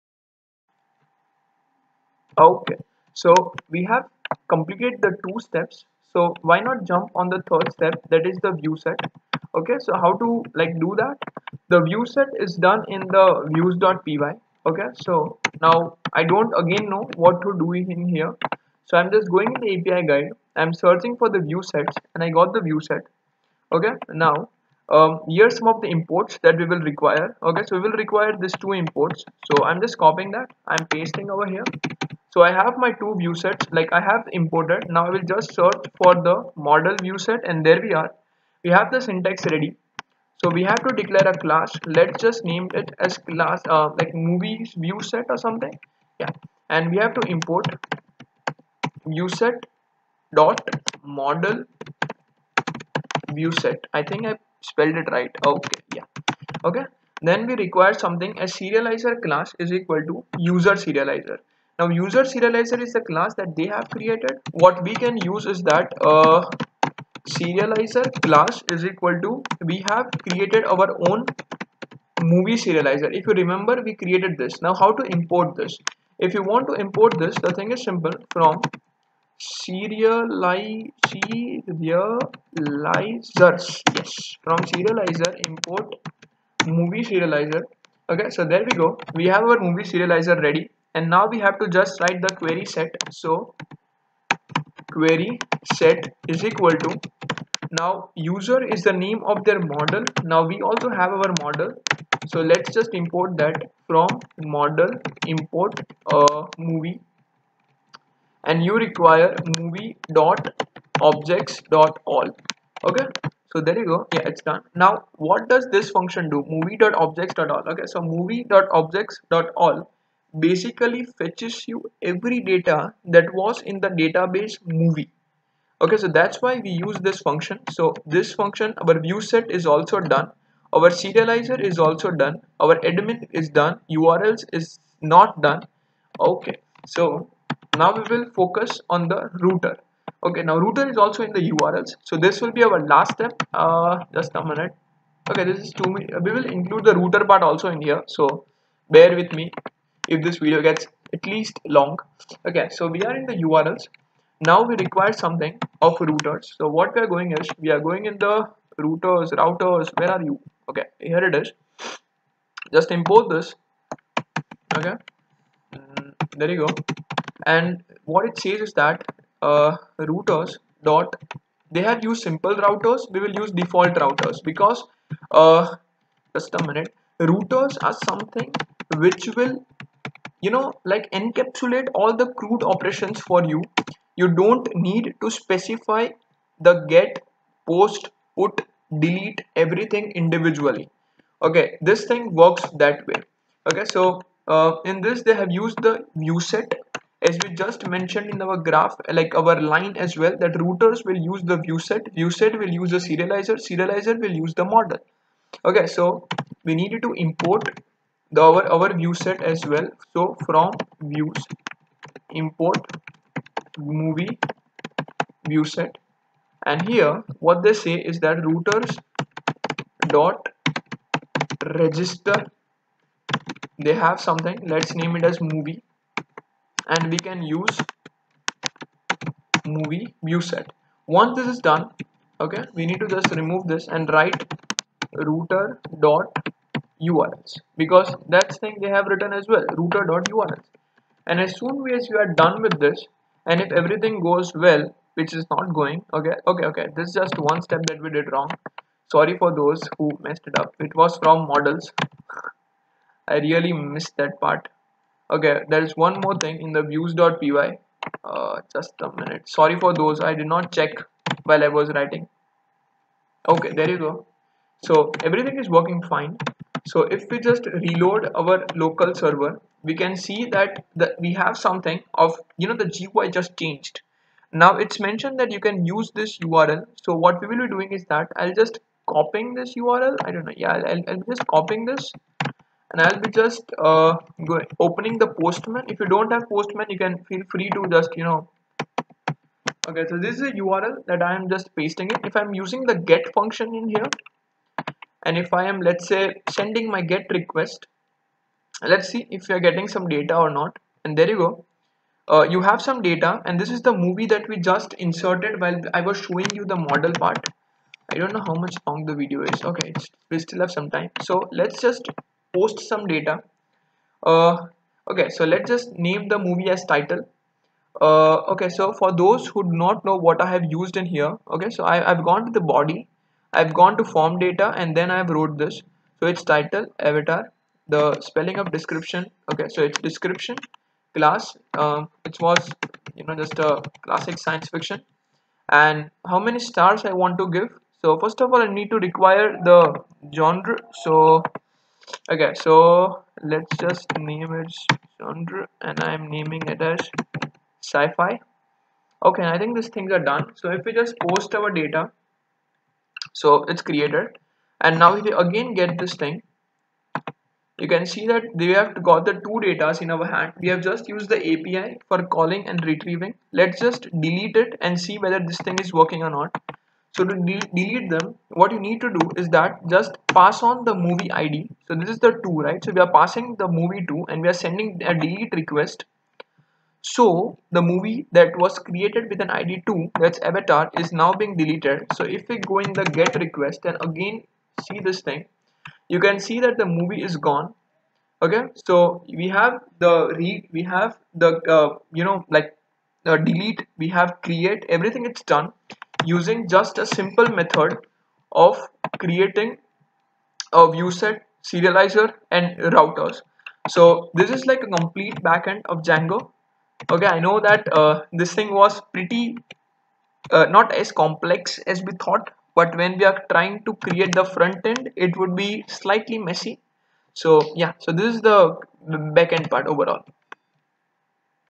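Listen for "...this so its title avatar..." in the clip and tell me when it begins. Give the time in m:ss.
5:25.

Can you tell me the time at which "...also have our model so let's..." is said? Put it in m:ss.
1:40.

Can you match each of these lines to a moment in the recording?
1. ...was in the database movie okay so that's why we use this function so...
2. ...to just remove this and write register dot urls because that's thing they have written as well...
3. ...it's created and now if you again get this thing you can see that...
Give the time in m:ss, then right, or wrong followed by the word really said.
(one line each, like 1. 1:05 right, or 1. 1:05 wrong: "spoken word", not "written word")
1. 2:03 right
2. 3:53 wrong: "router", not "register"
3. 5:53 right.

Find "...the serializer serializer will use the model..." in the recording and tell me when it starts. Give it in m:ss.
3:22.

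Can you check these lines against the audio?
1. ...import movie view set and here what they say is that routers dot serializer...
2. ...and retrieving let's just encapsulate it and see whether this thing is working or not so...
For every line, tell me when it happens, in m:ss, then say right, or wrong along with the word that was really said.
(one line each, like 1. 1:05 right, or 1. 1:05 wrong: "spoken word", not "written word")
1. 3:32 wrong: "register", not "serializer"
2. 6:02 wrong: "delete", not "encapsulate".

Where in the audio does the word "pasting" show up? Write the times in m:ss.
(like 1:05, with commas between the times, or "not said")
0:30, 4:51.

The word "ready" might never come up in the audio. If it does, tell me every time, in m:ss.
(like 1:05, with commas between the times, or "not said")
0:39, 1:30.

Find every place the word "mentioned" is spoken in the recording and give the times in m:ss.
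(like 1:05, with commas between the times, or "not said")
3:17, 4:34.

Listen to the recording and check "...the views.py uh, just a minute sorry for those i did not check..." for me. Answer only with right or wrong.
right.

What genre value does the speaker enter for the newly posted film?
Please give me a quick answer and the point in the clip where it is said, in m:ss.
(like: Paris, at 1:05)
sci-fi, at 5:47.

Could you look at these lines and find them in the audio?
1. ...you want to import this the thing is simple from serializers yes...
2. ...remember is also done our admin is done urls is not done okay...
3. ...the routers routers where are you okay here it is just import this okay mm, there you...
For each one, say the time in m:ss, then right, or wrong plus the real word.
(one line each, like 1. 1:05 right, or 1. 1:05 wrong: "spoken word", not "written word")
1. 1:16 right
2. 2:10 wrong: "serializer", not "remember"
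3. 2:38 right.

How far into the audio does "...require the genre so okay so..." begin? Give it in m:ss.
5:38.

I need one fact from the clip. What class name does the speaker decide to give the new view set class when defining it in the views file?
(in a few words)
movies view set.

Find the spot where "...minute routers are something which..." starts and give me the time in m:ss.
2:56.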